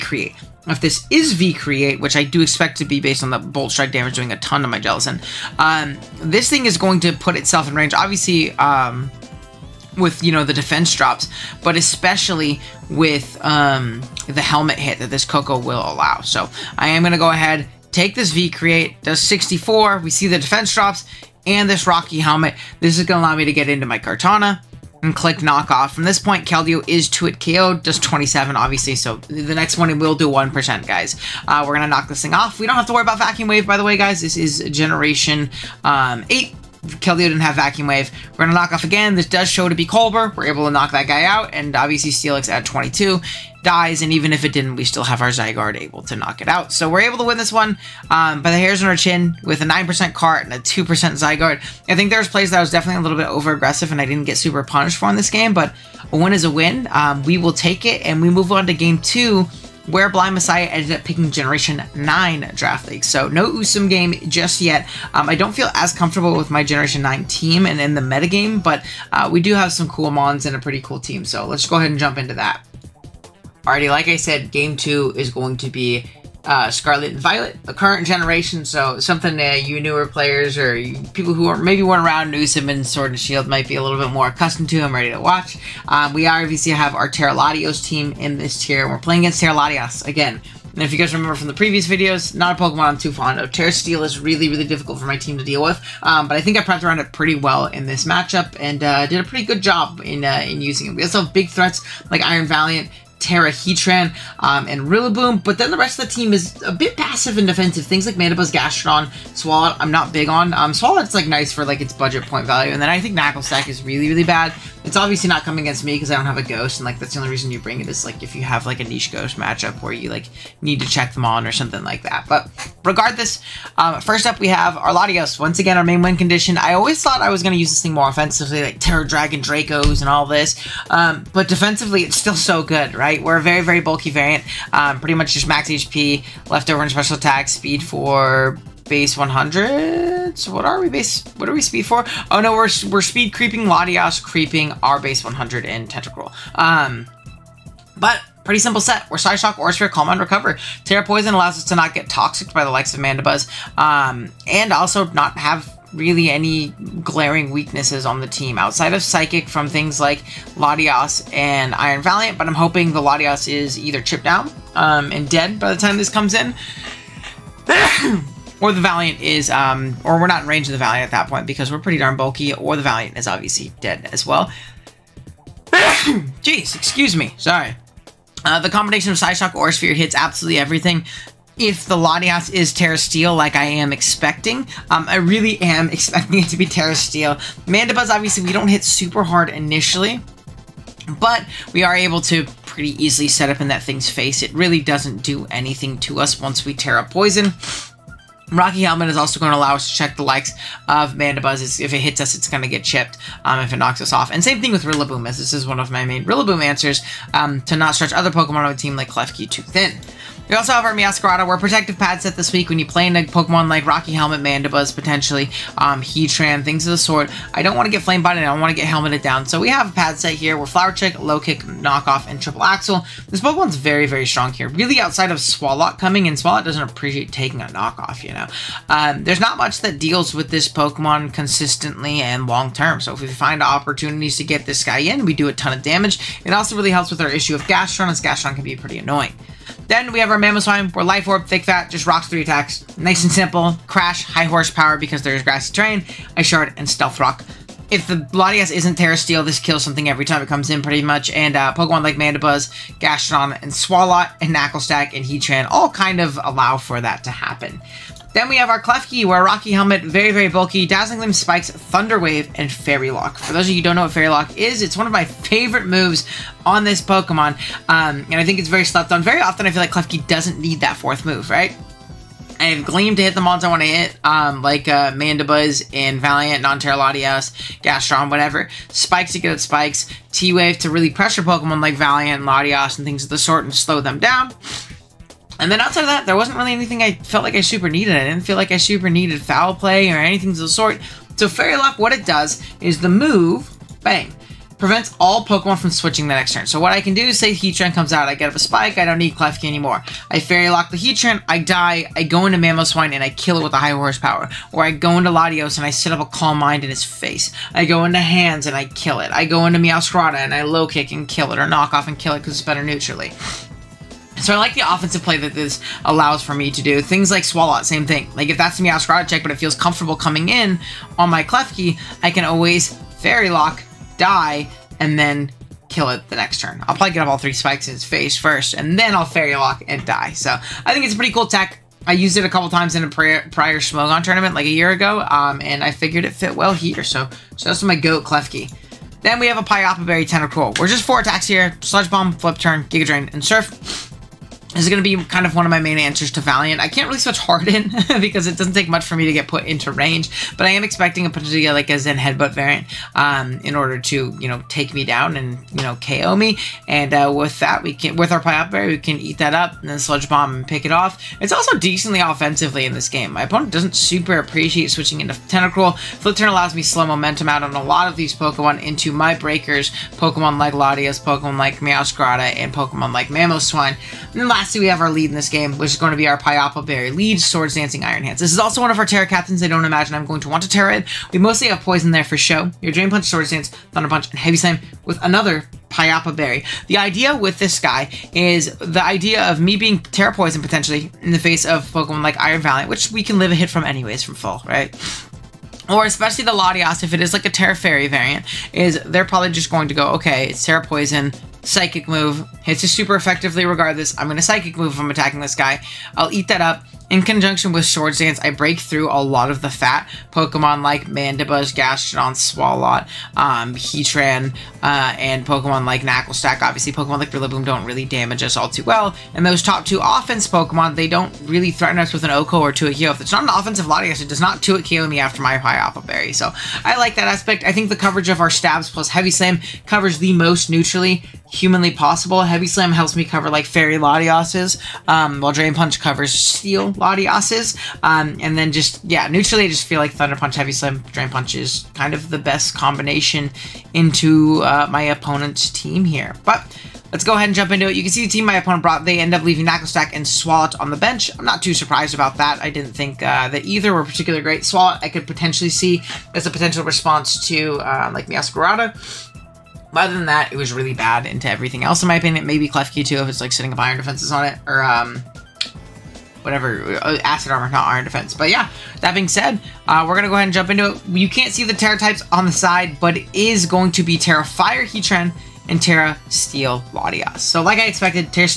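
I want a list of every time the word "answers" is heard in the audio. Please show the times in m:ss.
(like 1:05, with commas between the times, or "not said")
3:26, 5:45.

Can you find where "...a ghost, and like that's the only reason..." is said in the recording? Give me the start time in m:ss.
1:56.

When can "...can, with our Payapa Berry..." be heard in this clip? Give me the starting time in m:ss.
5:57.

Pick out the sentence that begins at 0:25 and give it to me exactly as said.
From this point, Keldeo is to it KO, does 27, obviously, so the next one will do 1%, guys.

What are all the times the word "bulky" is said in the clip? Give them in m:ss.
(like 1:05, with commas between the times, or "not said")
2:13, 2:52, 4:20.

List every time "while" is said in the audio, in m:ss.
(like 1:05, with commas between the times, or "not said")
7:15.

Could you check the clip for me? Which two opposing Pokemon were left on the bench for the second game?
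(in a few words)
Knacklestack and Swalot.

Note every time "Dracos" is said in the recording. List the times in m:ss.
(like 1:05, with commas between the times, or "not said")
2:09.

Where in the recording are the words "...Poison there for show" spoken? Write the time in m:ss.
6:21.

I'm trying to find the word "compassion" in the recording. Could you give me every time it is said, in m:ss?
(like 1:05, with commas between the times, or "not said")
not said.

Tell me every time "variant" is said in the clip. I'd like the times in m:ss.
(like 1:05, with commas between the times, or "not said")
2:14, 5:52, 6:38.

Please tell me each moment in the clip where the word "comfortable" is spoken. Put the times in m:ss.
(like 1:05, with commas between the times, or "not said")
1:05, 5:19.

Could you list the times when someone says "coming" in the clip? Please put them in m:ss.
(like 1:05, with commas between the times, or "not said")
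1:55, 3:45, 5:20.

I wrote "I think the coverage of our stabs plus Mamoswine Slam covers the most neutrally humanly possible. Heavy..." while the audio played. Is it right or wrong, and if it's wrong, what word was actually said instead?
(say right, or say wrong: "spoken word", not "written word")
wrong: "Heavy", not "Mamoswine".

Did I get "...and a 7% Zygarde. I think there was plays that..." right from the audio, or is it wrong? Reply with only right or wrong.
wrong.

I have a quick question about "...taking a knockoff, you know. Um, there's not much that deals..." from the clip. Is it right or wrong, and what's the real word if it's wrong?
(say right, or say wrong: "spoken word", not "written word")
right.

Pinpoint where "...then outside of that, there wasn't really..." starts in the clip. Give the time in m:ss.
4:45.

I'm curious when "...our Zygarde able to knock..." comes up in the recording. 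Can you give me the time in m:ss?
0:45.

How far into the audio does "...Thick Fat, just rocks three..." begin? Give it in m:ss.
4:01.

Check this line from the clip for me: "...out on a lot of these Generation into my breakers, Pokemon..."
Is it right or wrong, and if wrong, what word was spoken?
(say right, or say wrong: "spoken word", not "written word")
wrong: "Pokemon", not "Generation".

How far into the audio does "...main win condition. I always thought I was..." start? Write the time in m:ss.
2:05.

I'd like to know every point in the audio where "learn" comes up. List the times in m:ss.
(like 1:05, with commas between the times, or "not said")
not said.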